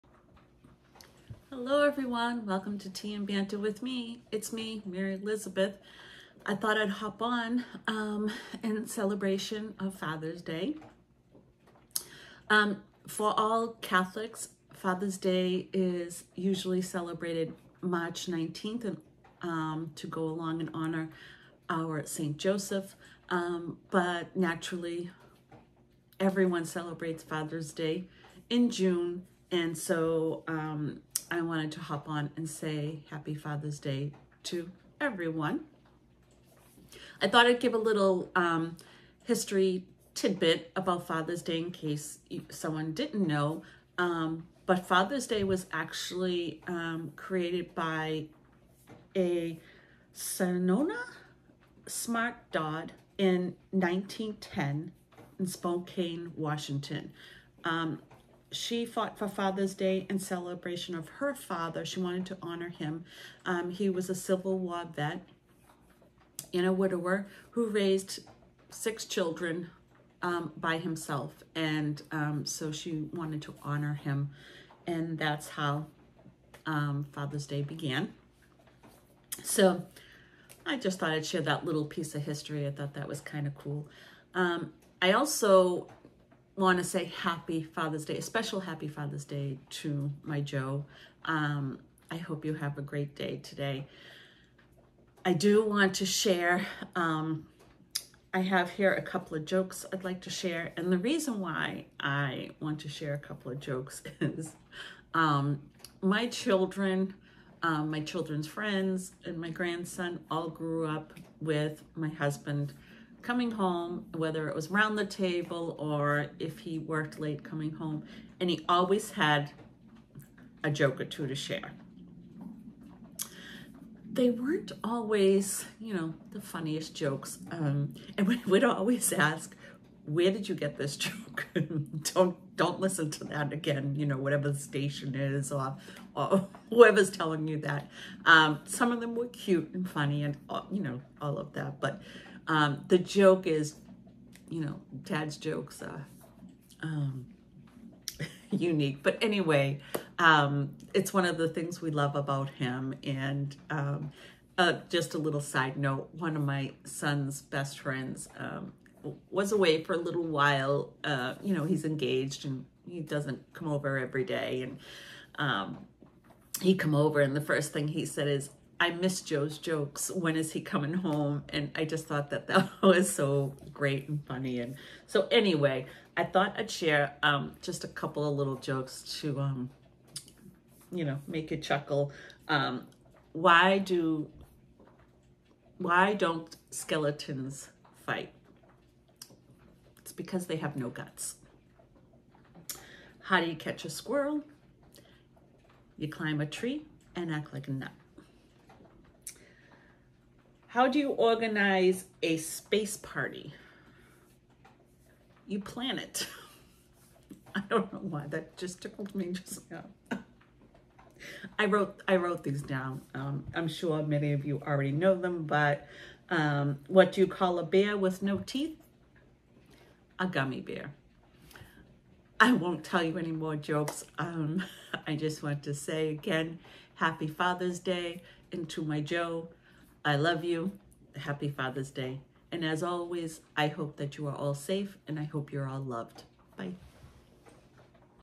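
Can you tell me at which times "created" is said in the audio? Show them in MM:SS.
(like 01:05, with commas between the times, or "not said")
00:47.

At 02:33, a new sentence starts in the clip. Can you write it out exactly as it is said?
And um, uh, just a little side note, one of my son's best friends um, was away for a little while.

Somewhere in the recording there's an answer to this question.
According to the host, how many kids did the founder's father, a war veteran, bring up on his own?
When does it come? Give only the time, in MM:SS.
01:08.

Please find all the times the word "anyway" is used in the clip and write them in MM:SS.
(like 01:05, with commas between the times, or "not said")
02:29, 02:55.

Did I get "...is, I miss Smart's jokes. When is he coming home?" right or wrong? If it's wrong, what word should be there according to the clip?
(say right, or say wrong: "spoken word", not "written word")
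wrong: "Joe", not "Smart".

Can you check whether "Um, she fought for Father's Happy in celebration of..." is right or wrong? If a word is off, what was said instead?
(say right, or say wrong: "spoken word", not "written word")
wrong: "Day", not "Happy".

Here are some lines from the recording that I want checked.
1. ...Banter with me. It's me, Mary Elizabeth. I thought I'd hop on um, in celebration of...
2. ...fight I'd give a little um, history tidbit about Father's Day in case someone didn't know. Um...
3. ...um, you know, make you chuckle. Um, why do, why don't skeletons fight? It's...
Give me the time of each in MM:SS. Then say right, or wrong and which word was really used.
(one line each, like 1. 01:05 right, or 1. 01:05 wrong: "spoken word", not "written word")
1. 00:03 right
2. 00:37 wrong: "thought", not "fight"
3. 02:59 right.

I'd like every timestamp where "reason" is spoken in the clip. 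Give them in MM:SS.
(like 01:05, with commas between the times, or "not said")
01:40.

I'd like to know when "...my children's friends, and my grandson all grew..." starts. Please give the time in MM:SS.
01:47.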